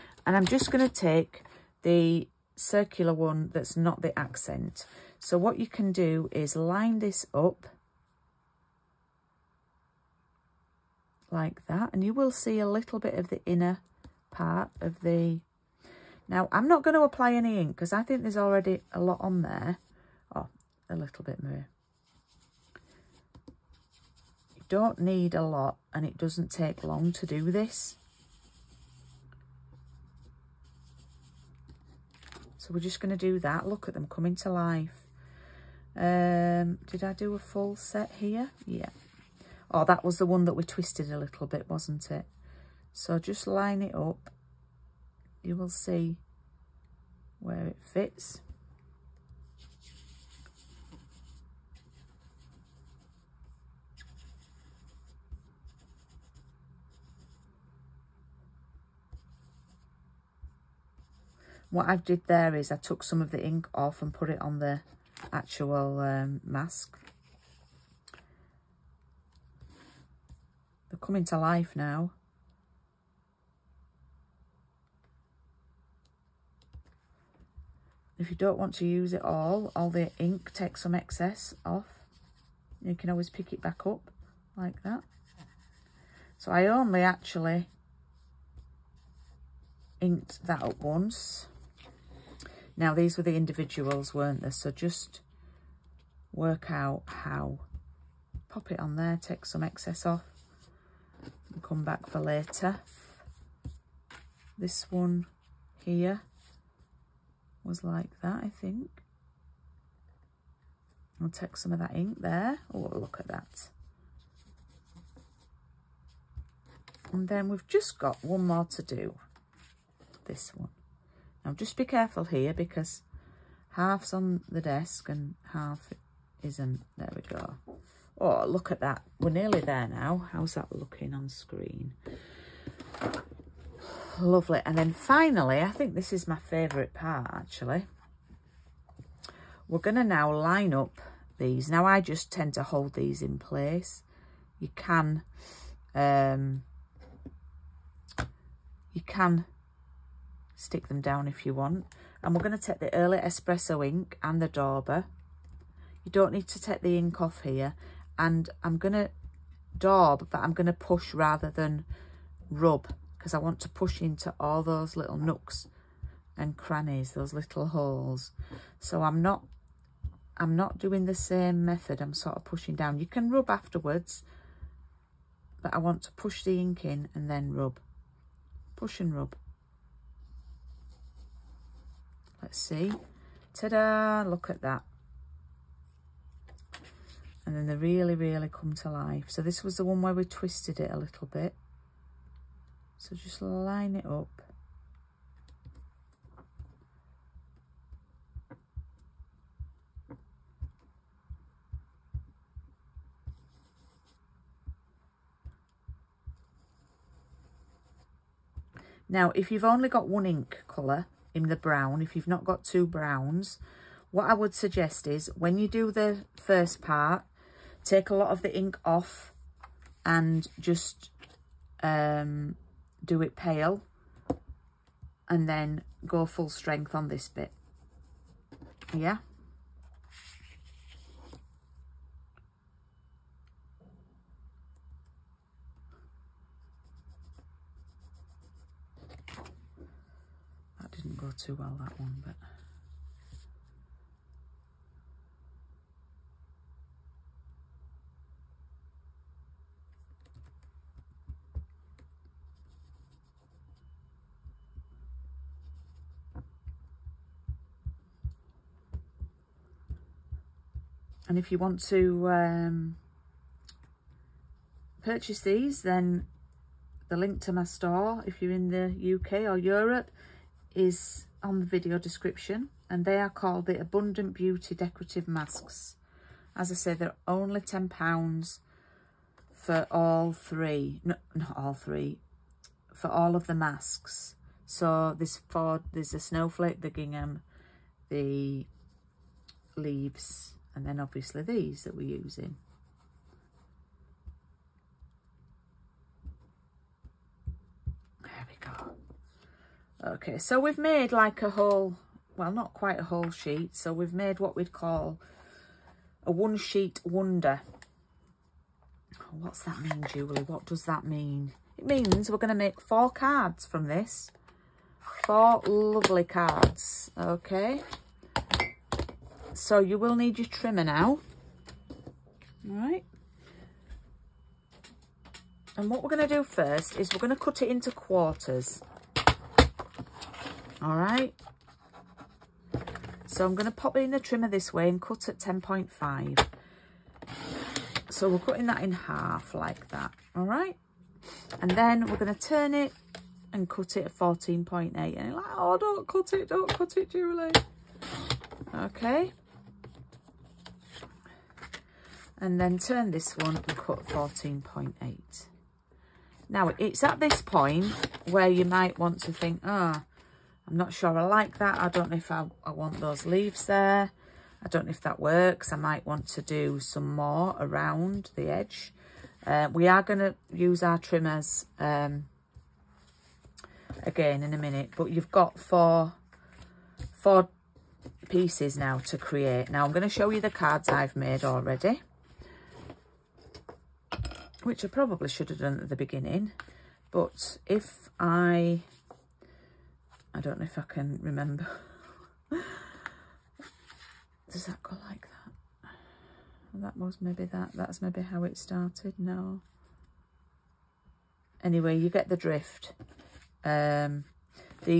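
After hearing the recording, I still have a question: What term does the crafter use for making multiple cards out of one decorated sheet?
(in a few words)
one sheet wonder.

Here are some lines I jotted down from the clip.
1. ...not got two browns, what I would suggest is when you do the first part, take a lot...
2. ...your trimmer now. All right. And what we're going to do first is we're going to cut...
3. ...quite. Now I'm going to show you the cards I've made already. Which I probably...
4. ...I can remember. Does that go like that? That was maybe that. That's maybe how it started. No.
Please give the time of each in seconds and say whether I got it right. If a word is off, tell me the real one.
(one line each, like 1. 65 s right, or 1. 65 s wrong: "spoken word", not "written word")
1. 212 s right
2. 320 s right
3. 379 s wrong: "create", not "quite"
4. 390 s right.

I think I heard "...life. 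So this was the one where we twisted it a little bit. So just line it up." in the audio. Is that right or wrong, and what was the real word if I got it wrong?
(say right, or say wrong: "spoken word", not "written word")
right.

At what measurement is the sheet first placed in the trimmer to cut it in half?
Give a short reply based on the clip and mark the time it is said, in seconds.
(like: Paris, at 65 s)
10.5, at 335 s.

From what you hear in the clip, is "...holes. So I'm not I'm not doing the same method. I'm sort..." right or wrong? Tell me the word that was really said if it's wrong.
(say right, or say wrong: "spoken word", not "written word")
right.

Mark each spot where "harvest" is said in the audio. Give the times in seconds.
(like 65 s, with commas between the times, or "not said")
not said.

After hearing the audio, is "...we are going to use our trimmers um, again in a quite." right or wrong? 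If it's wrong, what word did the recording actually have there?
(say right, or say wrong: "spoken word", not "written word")
wrong: "minute", not "quite".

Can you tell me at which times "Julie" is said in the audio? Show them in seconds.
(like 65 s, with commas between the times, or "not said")
310 s, 347 s.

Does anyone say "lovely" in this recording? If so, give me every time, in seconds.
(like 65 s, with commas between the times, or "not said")
134 s, 315 s.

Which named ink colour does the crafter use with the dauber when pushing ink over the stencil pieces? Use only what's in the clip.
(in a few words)
Early Espresso.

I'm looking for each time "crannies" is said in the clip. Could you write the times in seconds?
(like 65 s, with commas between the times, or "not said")
166 s.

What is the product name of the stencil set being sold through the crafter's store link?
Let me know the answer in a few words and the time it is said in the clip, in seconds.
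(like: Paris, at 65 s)
Abundant Beauty Decorative Masks, at 273 s.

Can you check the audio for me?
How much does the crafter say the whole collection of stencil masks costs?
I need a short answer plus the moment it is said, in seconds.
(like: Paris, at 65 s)
£10, at 277 s.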